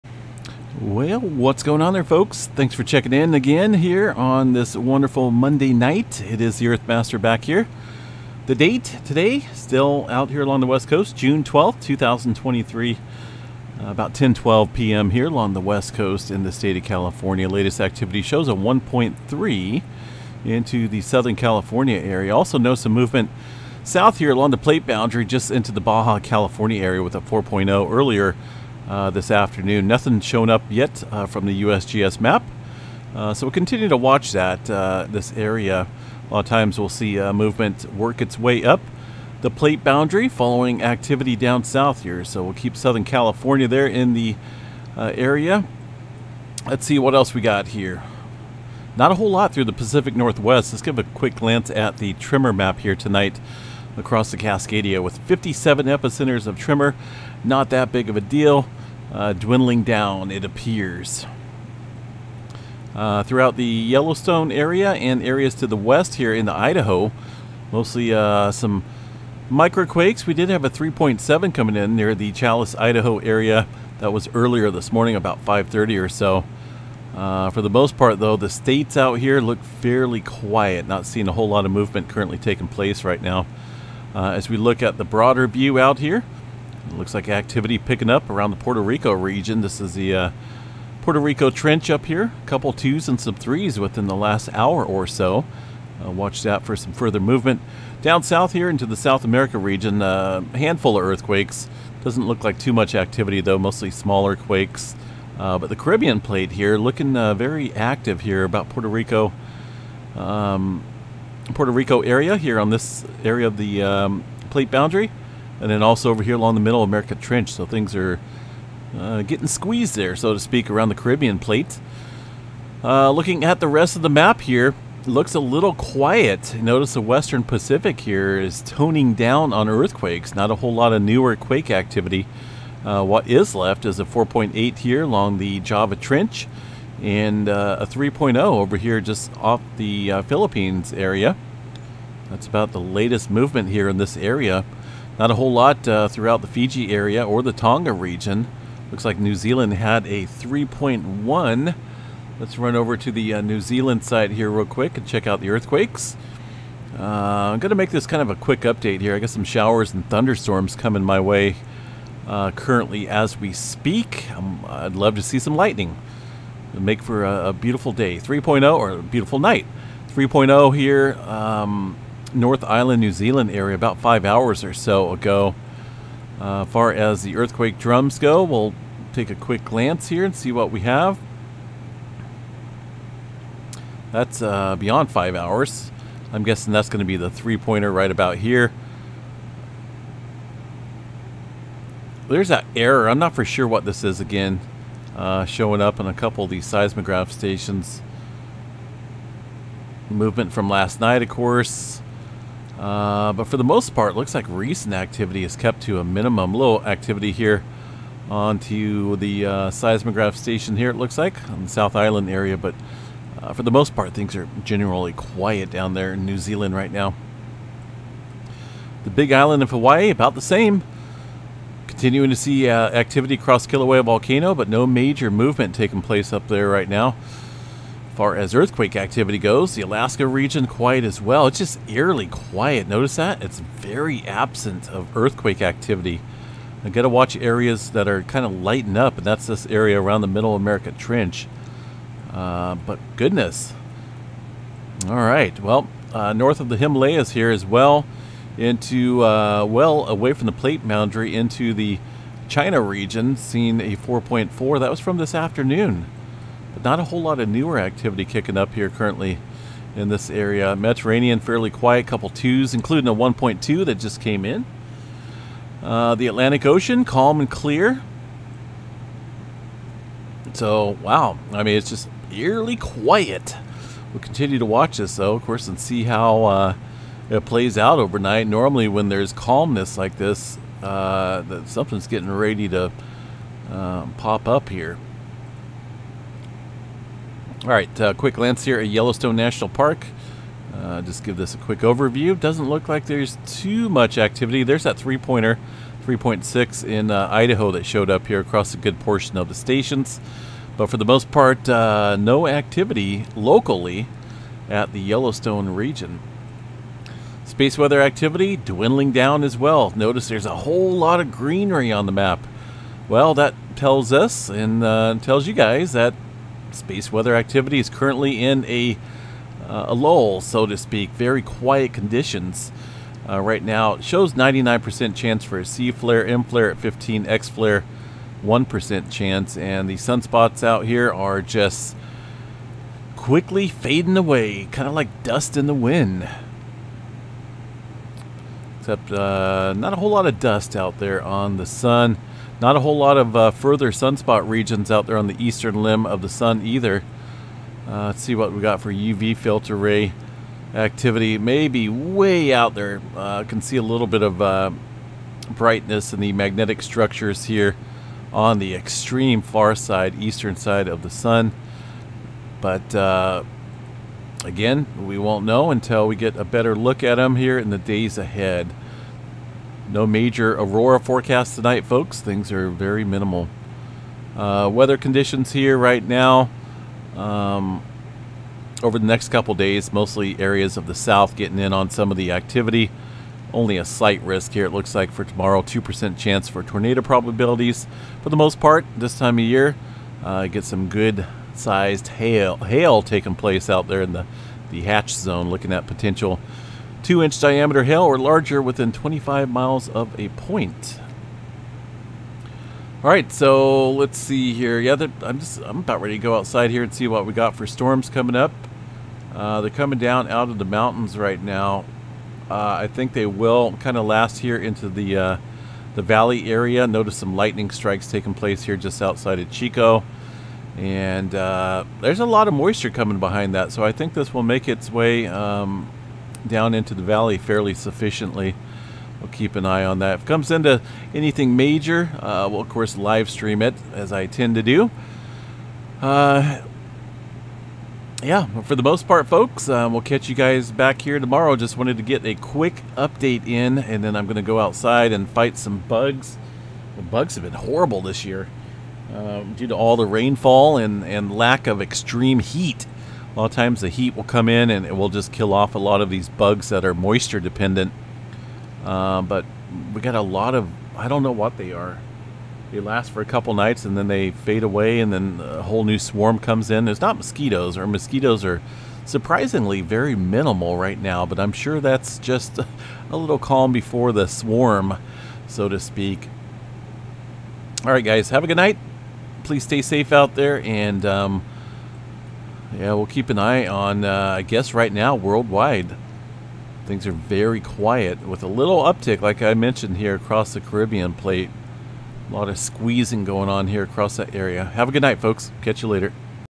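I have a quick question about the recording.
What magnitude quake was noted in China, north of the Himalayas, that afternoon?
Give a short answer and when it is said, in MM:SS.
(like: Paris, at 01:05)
4.4, at 04:13.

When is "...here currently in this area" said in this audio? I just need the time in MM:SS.
04:18.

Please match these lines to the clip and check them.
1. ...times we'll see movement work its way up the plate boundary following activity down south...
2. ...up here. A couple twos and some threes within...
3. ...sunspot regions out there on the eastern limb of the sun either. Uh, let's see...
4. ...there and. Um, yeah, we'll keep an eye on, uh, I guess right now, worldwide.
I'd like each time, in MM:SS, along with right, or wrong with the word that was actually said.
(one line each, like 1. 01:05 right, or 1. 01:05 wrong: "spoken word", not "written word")
1. 00:36 right
2. 01:31 right
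3. 05:43 right
4. 08:00 right.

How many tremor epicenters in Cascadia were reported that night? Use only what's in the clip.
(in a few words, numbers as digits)
57.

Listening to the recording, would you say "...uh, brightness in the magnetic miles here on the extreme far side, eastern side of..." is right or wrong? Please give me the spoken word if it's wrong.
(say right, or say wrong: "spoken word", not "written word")
wrong: "structures", not "miles".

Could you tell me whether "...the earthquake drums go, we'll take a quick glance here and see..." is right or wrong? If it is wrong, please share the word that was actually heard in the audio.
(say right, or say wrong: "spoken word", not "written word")
right.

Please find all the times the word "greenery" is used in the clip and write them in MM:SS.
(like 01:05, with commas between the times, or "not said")
05:11.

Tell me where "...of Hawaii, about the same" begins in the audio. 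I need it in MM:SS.
03:39.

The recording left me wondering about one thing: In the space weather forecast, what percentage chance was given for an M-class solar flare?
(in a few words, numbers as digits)
15%.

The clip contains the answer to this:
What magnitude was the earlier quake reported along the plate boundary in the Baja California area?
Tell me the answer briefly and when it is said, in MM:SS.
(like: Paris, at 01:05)
4.0, at 00:27.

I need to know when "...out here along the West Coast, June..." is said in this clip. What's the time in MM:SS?
00:10.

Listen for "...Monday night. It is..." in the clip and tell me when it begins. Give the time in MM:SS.
00:05.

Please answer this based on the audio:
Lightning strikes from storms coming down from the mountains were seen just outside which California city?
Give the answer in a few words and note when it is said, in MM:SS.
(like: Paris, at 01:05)
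Chico, at 06:59.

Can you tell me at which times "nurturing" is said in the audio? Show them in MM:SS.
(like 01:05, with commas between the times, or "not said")
not said.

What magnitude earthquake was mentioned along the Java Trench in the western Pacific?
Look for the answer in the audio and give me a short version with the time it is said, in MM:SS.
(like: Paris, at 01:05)
4.8, at 02:14.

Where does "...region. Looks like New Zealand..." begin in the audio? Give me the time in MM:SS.
02:27.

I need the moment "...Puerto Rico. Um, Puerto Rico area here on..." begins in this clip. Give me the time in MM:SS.
01:48.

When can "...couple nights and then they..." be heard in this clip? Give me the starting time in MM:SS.
07:43.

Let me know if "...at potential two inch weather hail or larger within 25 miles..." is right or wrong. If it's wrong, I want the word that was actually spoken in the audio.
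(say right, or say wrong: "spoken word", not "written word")
wrong: "diameter", not "weather".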